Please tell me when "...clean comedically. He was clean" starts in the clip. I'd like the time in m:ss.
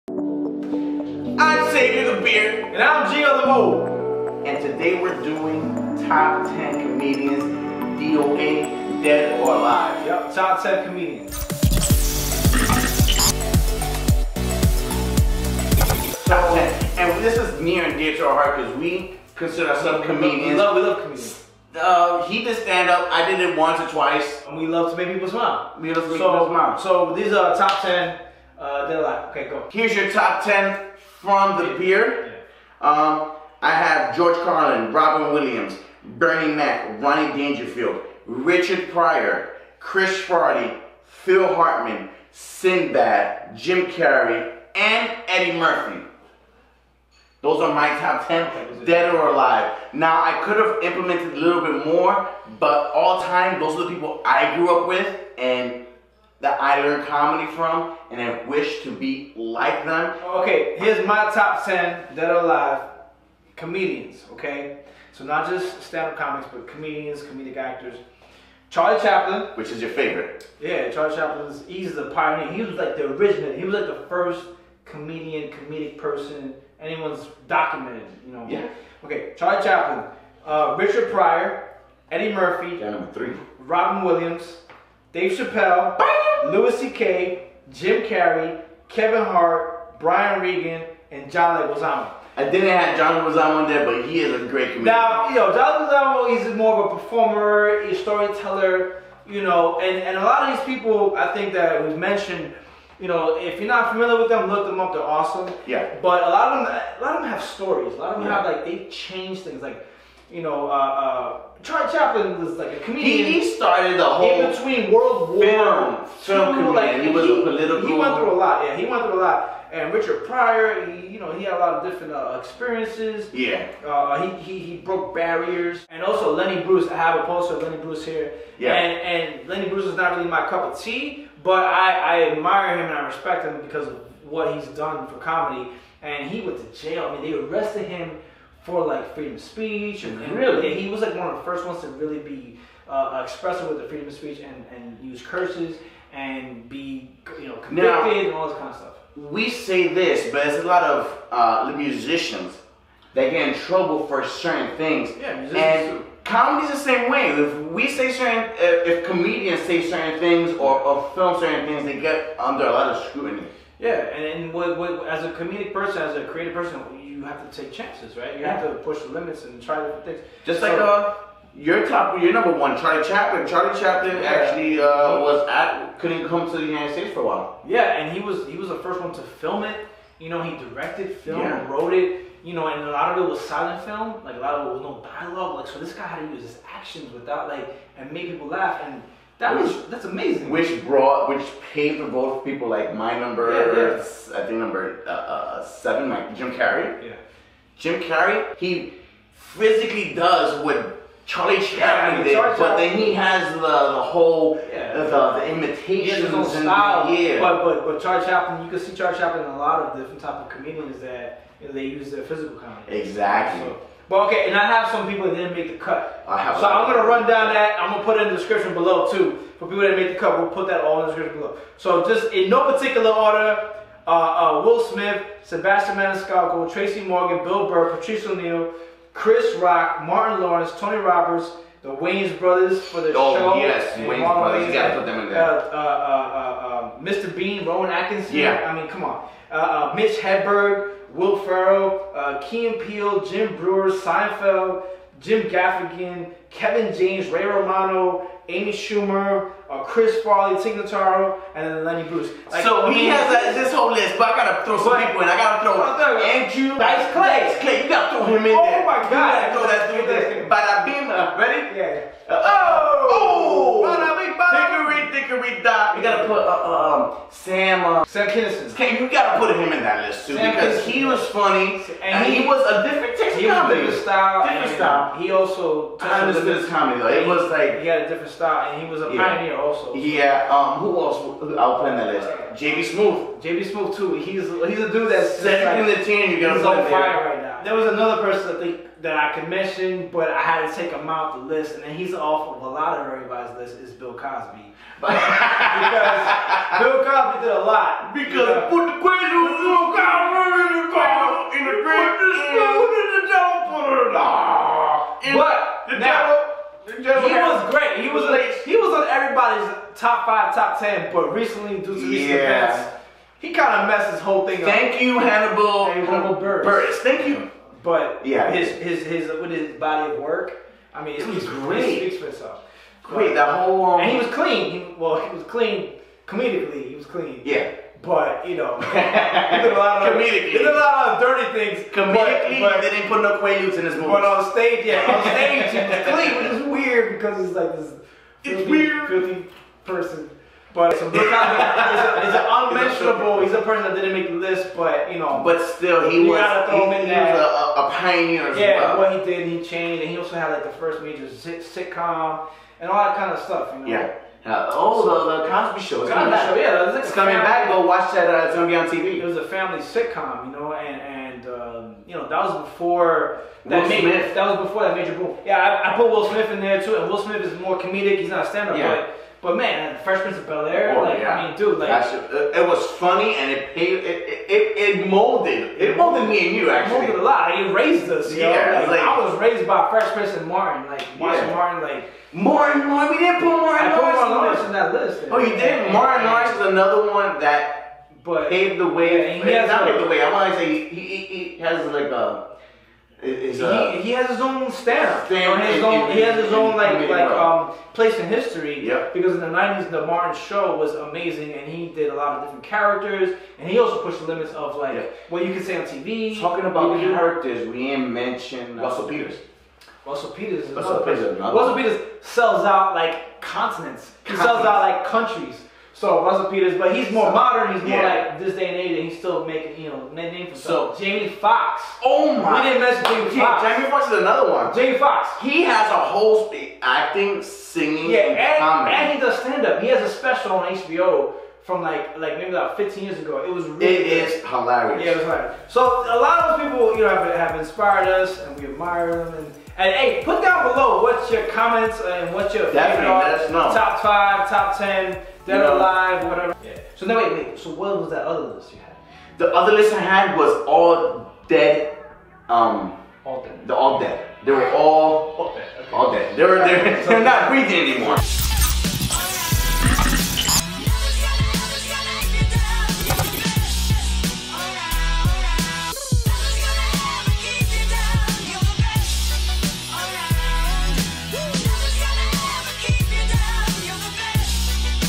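5:25.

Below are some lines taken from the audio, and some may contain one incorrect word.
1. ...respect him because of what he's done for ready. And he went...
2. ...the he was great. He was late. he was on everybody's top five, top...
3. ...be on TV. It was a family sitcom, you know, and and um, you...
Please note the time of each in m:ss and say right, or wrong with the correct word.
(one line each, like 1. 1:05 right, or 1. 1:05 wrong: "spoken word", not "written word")
1. 2:13 wrong: "comedy", not "ready"
2. 5:07 right
3. 5:58 right.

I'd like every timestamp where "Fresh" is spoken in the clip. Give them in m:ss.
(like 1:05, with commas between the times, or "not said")
6:10, 6:19.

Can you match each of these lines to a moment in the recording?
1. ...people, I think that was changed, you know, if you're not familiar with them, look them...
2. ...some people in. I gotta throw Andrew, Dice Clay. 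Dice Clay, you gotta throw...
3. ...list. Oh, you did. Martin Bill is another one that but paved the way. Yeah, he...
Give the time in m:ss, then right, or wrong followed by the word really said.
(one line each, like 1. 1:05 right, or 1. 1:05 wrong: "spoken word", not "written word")
1. 1:40 wrong: "mentioned", not "changed"
2. 4:14 right
3. 6:24 wrong: "Lawrence", not "Bill".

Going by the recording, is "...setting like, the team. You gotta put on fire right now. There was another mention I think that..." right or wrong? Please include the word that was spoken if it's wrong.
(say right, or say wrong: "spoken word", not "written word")
wrong: "person", not "mention".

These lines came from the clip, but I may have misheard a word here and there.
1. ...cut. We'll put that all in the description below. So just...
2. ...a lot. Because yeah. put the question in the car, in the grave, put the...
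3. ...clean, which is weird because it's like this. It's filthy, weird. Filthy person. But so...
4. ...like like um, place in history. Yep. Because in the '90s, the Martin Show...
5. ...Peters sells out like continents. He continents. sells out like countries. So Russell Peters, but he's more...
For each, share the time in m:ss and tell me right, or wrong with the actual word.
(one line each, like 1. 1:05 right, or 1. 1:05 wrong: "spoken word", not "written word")
1. 3:40 right
2. 4:57 right
3. 5:36 right
4. 6:36 right
5. 6:51 right.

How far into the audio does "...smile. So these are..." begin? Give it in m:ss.
0:26.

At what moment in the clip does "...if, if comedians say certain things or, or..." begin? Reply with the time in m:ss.
2:38.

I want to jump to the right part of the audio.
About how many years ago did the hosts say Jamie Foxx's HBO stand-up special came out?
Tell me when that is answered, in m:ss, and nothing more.
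7:12.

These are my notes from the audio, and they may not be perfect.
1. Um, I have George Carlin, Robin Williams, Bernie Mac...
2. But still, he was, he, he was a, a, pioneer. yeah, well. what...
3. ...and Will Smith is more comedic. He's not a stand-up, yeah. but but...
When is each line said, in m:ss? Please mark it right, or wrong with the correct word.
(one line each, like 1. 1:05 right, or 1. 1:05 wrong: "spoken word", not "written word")
1. 0:32 right
2. 5:45 right
3. 6:06 right.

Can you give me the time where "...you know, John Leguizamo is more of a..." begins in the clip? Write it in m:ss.
1:35.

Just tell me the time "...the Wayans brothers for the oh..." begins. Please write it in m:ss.
3:51.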